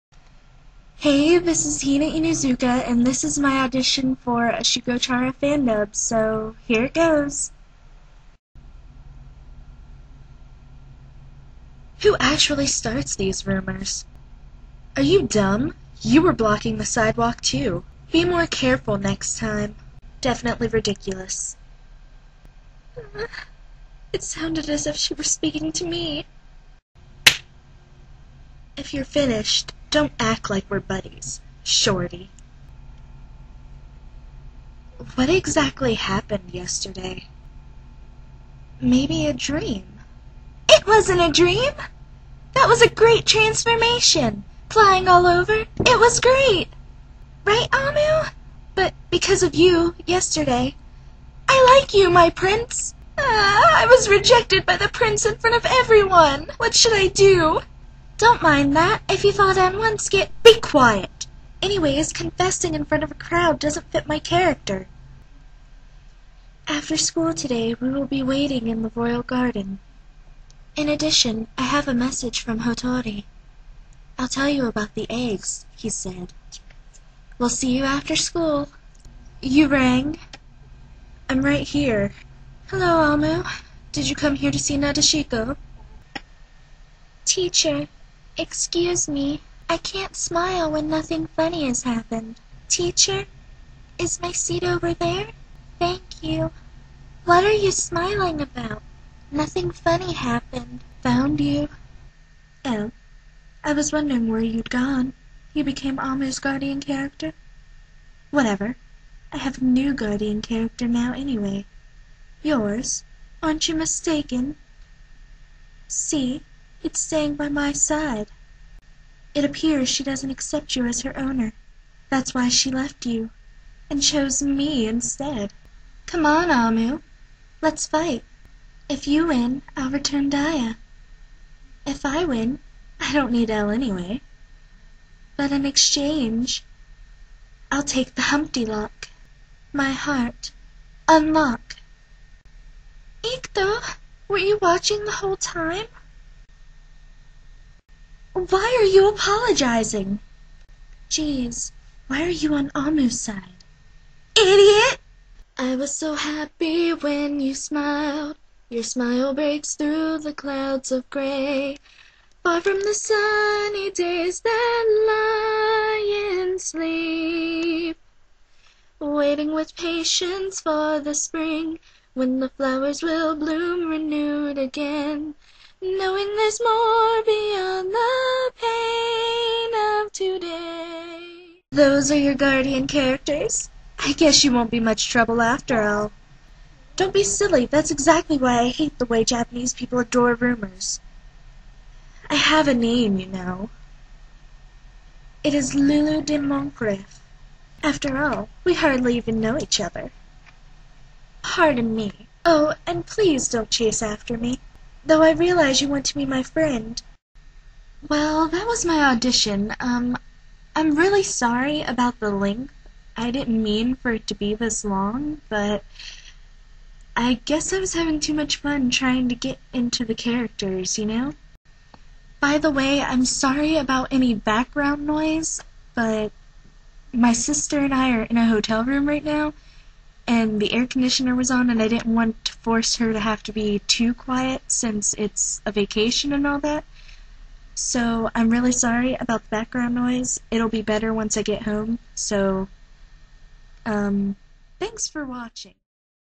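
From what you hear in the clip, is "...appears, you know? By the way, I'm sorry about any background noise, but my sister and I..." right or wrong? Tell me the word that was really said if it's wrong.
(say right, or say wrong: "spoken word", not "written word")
wrong: "characters", not "appears".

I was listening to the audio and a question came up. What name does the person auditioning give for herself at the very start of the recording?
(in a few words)
Hina Inuzuka.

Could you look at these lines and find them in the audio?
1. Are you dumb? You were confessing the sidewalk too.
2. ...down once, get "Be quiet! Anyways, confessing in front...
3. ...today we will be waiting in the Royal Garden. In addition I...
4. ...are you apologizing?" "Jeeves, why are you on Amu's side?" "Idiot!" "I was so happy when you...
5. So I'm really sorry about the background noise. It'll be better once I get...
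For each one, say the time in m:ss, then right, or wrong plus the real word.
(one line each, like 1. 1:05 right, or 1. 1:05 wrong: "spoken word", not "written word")
1. 0:14 wrong: "blocking", not "confessing"
2. 0:59 right
3. 1:07 right
4. 2:28 right
5. 3:57 right.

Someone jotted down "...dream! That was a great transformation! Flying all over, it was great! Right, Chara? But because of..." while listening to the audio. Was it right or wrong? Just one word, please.
wrong.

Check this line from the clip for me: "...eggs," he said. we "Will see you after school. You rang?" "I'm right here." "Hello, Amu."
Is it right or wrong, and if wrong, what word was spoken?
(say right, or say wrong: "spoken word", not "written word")
right.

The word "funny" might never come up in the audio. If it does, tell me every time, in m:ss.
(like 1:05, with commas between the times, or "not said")
1:31, 1:39.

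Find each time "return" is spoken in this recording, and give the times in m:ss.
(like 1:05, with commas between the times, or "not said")
2:09.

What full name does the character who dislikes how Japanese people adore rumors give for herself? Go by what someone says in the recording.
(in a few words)
Lulu de Montgolfier.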